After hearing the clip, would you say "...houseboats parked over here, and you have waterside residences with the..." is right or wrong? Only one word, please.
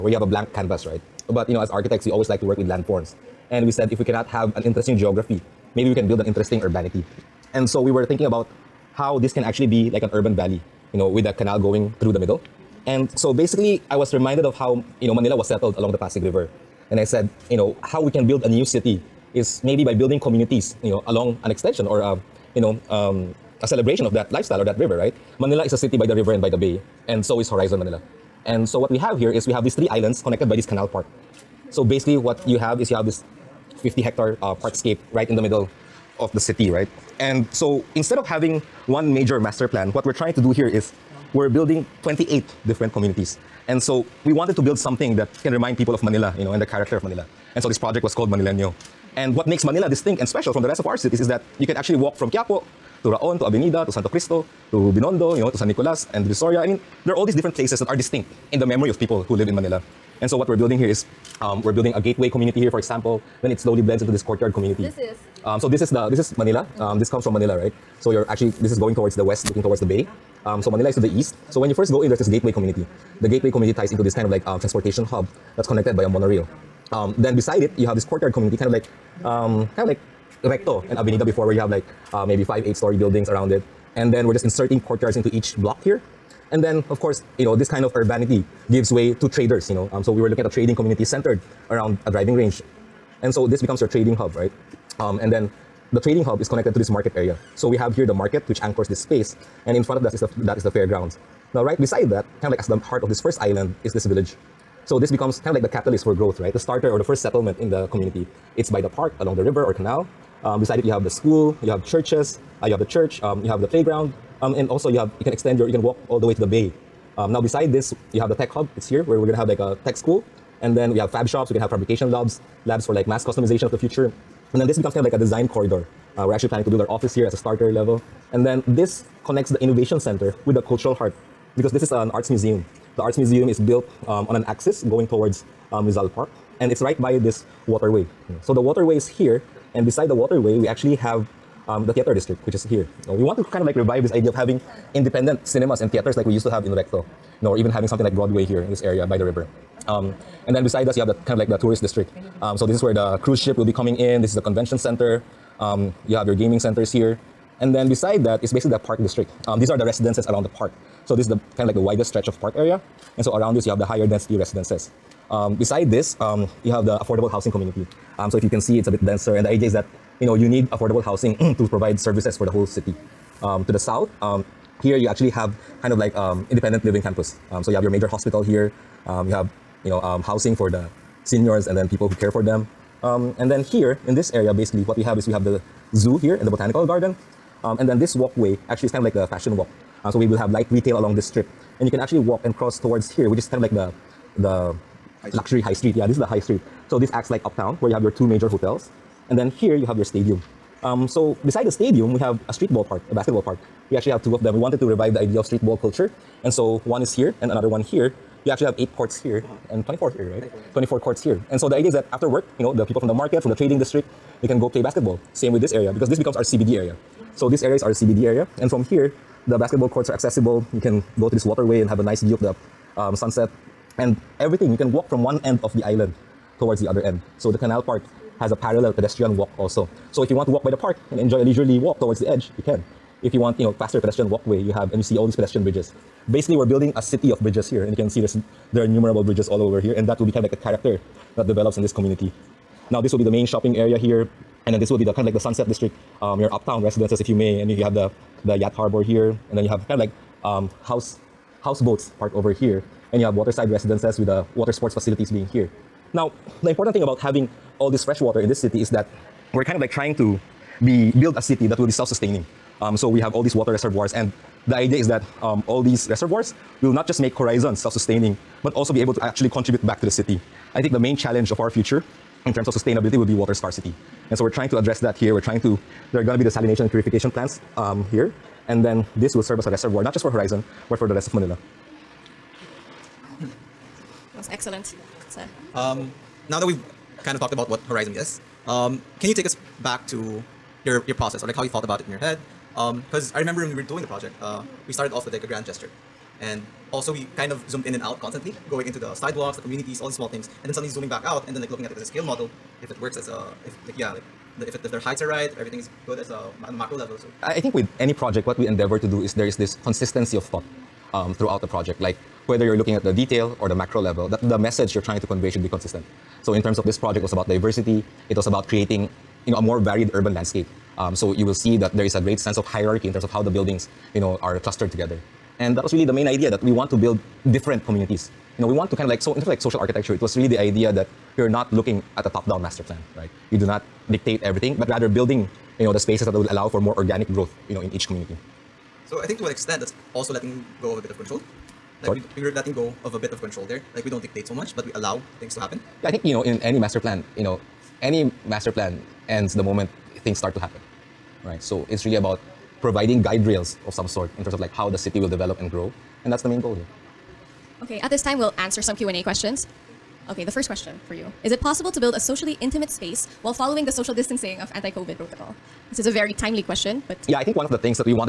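right.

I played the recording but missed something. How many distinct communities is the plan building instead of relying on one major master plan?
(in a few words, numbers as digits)
28.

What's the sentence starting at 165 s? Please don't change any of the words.
Um, beside this, um, you have the affordable housing community.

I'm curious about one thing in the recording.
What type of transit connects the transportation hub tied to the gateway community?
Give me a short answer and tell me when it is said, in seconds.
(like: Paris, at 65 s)
monorail, at 76 s.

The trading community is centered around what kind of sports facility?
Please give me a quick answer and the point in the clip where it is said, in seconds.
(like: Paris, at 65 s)
driving range, at 92 s.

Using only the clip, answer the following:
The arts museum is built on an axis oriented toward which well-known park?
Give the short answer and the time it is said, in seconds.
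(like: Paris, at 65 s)
Rizal Park, at 135 s.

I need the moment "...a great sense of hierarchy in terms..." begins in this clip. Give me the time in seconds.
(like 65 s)
322 s.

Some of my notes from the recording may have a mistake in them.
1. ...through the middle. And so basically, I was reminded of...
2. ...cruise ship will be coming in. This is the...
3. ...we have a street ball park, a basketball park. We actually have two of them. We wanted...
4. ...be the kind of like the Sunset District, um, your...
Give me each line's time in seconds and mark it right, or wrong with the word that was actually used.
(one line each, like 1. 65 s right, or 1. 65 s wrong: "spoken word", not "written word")
1. 12 s right
2. 153 s right
3. 202 s right
4. 244 s right.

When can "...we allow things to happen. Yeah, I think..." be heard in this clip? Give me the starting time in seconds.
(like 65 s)
344 s.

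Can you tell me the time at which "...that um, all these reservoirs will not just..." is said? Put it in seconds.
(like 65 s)
265 s.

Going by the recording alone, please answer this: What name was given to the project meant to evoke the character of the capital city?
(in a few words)
Manileño.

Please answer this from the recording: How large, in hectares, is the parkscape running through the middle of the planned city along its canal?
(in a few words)
50 hectares.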